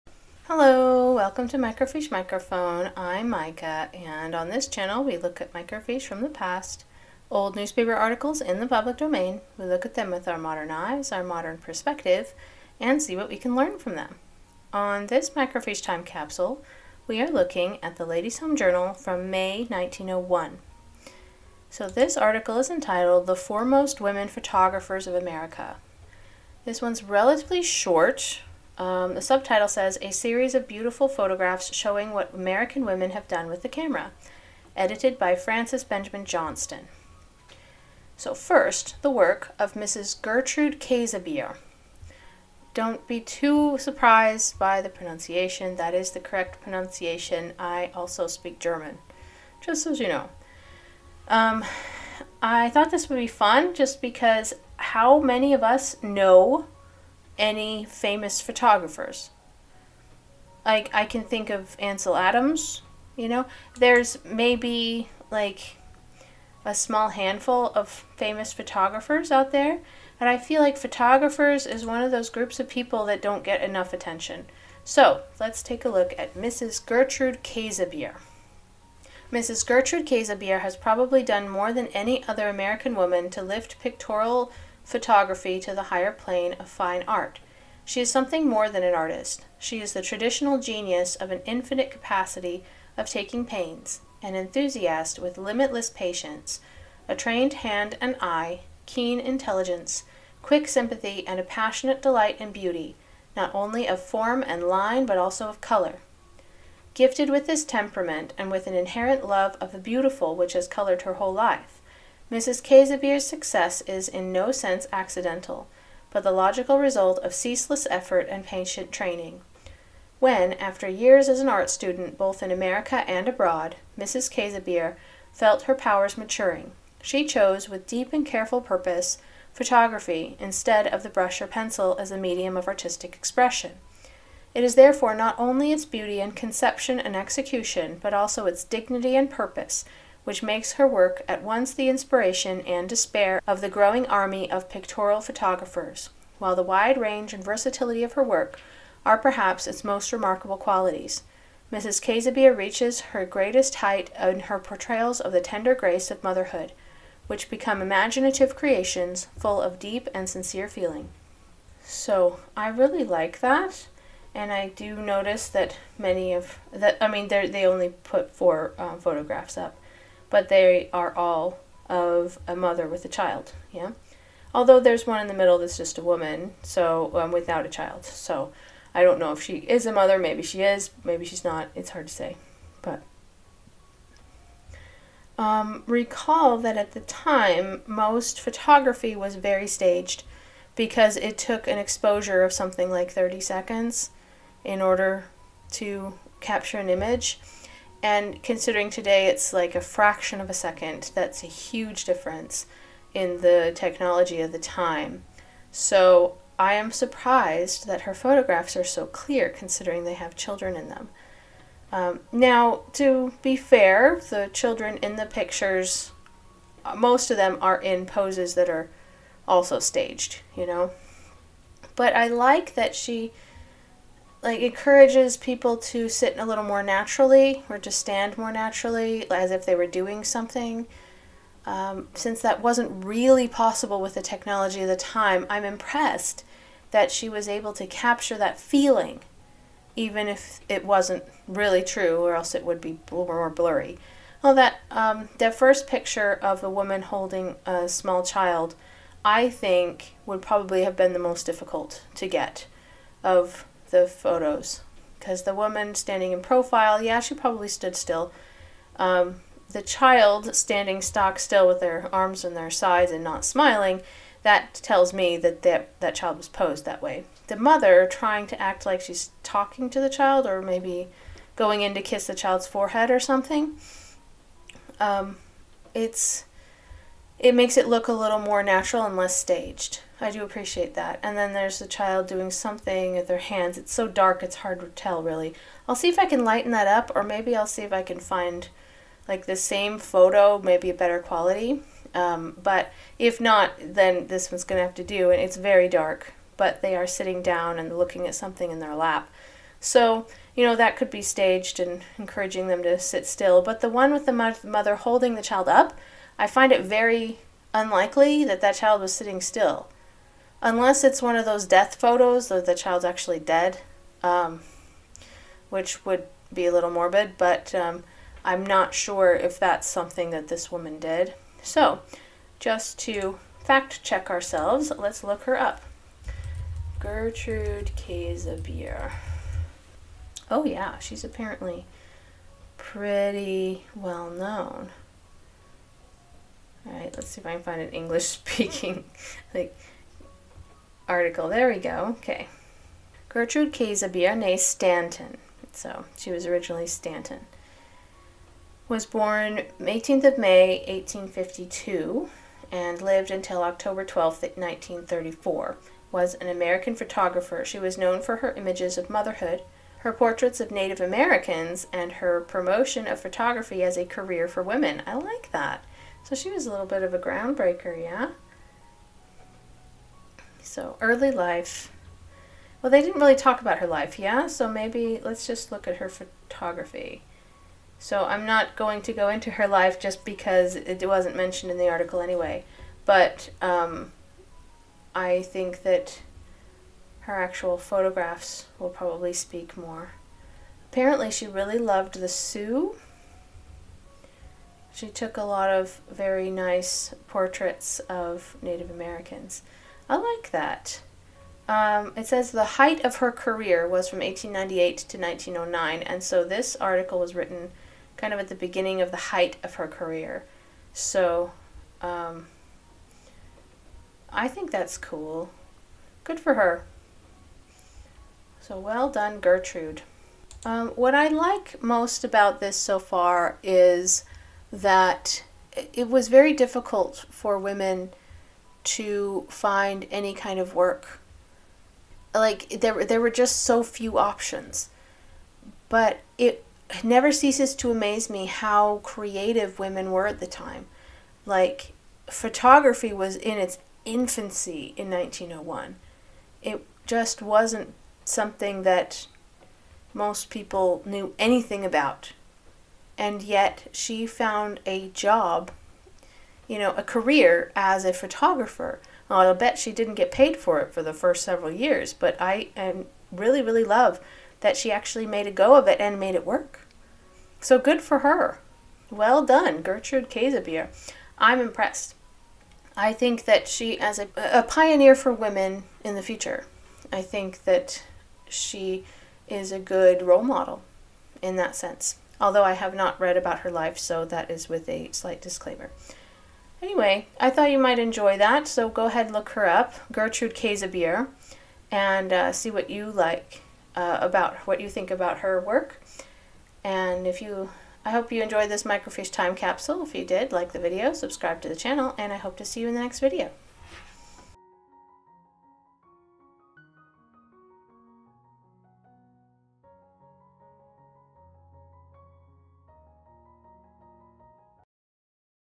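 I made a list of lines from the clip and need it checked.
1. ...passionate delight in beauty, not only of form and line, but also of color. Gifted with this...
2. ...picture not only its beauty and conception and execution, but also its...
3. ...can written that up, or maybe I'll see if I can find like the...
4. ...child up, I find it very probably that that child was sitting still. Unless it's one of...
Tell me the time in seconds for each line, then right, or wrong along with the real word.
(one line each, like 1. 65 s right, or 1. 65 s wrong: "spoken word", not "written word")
1. 101 s right
2. 134 s wrong: "therefore", not "picture"
3. 286 s wrong: "lighten", not "written"
4. 305 s wrong: "unlikely", not "probably".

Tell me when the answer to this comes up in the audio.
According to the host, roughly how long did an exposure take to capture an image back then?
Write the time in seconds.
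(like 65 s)
193 s.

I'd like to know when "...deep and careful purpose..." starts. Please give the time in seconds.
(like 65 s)
127 s.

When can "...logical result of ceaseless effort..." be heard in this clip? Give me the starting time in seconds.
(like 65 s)
116 s.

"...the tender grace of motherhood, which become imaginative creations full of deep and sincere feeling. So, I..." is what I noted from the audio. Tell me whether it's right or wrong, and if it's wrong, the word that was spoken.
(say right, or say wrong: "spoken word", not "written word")
right.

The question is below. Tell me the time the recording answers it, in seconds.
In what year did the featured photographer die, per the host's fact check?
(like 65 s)
354 s.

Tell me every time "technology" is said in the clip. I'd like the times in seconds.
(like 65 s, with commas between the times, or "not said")
203 s, 234 s.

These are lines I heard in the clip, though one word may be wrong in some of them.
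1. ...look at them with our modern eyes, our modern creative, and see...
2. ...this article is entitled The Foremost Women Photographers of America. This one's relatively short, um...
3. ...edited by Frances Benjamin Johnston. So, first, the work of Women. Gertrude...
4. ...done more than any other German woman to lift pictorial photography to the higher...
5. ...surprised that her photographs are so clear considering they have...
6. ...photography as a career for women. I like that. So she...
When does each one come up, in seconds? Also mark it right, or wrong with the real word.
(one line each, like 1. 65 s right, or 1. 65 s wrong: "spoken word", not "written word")
1. 9 s wrong: "perspective", not "creative"
2. 21 s right
3. 34 s wrong: "Mrs", not "Women"
4. 81 s wrong: "American", not "German"
5. 206 s right
6. 363 s right.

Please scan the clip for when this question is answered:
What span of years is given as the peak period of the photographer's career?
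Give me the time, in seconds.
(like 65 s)
404 s.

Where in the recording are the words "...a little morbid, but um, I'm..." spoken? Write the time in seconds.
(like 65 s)
316 s.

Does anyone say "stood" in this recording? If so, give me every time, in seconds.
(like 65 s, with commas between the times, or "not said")
257 s.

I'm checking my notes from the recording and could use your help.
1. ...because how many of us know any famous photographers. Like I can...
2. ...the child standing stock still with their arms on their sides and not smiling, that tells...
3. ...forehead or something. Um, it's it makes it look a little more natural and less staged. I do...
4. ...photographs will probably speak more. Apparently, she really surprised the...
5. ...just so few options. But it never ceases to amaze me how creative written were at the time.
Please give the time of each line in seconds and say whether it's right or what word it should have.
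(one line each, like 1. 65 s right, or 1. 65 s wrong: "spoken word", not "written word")
1. 54 s right
2. 259 s right
3. 272 s right
4. 387 s wrong: "loved", not "surprised"
5. 433 s wrong: "women", not "written".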